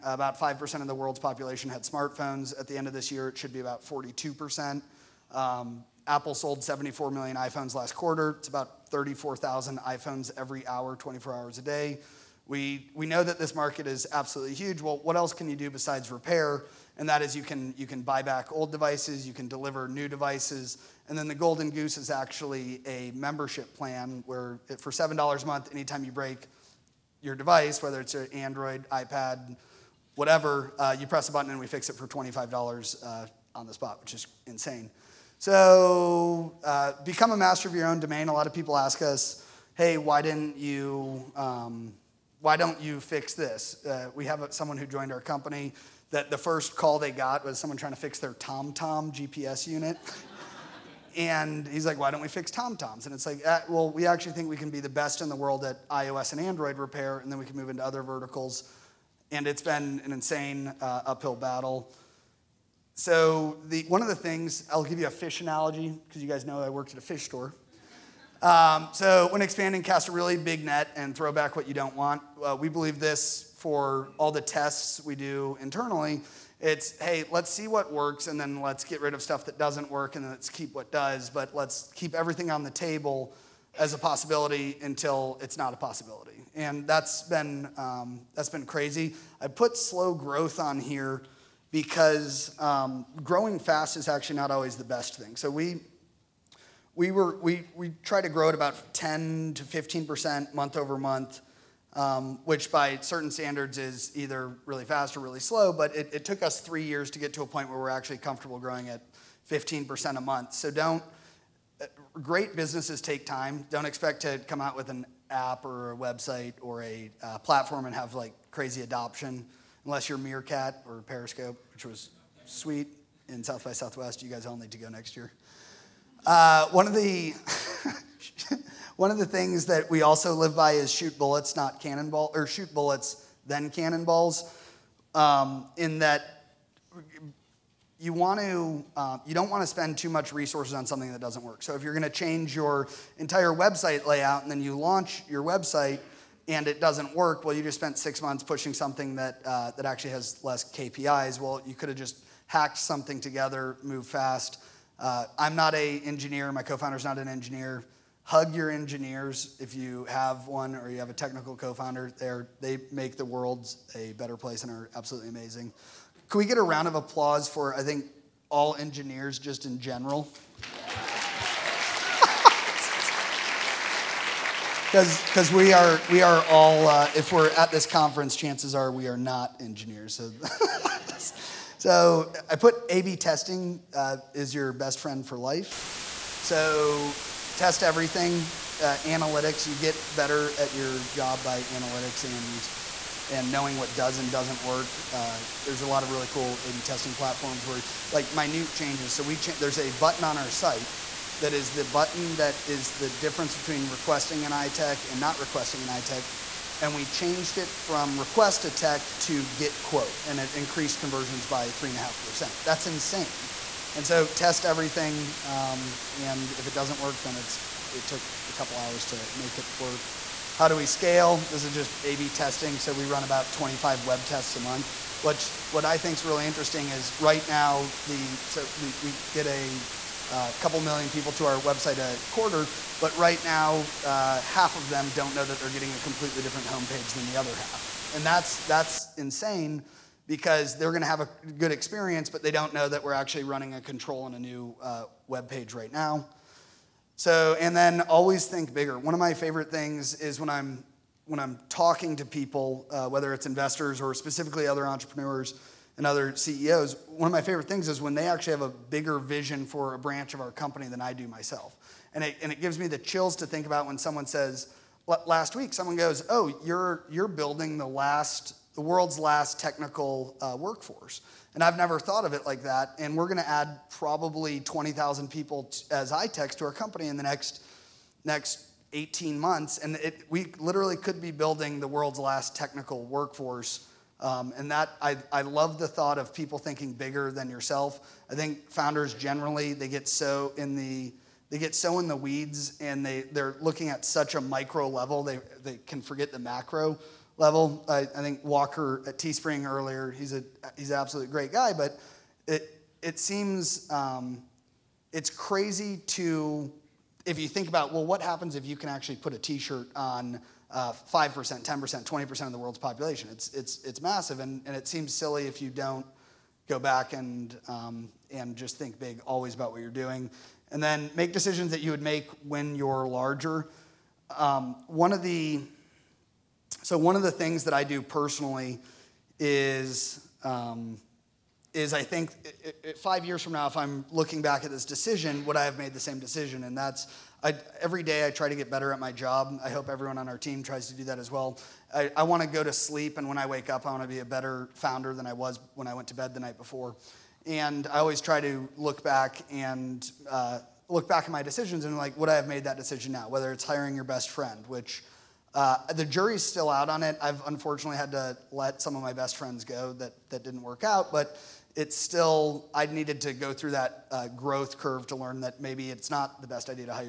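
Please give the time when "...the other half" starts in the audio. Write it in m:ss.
3:57.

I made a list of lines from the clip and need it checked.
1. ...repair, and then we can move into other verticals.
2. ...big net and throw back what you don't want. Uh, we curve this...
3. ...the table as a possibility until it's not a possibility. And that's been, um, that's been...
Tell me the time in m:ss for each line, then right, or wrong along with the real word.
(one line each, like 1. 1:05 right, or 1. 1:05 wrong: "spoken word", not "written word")
1. 0:56 right
2. 1:10 wrong: "believe", not "curve"
3. 1:22 right.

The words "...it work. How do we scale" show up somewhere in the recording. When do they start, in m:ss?
3:39.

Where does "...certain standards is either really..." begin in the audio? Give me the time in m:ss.
1:42.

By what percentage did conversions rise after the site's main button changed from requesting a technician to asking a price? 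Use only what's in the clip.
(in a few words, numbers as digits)
3.5%.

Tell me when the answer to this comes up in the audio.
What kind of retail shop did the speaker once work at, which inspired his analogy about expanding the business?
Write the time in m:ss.
1:07.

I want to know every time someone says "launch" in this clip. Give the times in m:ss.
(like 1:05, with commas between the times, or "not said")
2:24.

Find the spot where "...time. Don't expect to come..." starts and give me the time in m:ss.
1:53.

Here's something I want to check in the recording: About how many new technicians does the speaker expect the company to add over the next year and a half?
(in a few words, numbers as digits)
20,000.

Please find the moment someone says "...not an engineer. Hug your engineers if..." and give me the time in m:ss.
2:37.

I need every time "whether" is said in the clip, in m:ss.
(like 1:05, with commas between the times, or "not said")
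0:27, 4:13, 5:53.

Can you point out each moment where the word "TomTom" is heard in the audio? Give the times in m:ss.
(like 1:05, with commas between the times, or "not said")
0:48, 0:52.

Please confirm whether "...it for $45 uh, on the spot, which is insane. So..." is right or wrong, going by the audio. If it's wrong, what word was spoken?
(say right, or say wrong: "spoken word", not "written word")
wrong: "25", not "45".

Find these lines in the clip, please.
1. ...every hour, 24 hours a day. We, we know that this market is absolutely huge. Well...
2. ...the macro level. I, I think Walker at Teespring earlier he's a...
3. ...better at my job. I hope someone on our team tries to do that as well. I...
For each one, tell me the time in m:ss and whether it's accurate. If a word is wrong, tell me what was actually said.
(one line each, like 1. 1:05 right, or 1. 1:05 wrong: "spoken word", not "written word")
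1. 0:10 right
2. 4:56 right
3. 5:38 wrong: "everyone", not "someone".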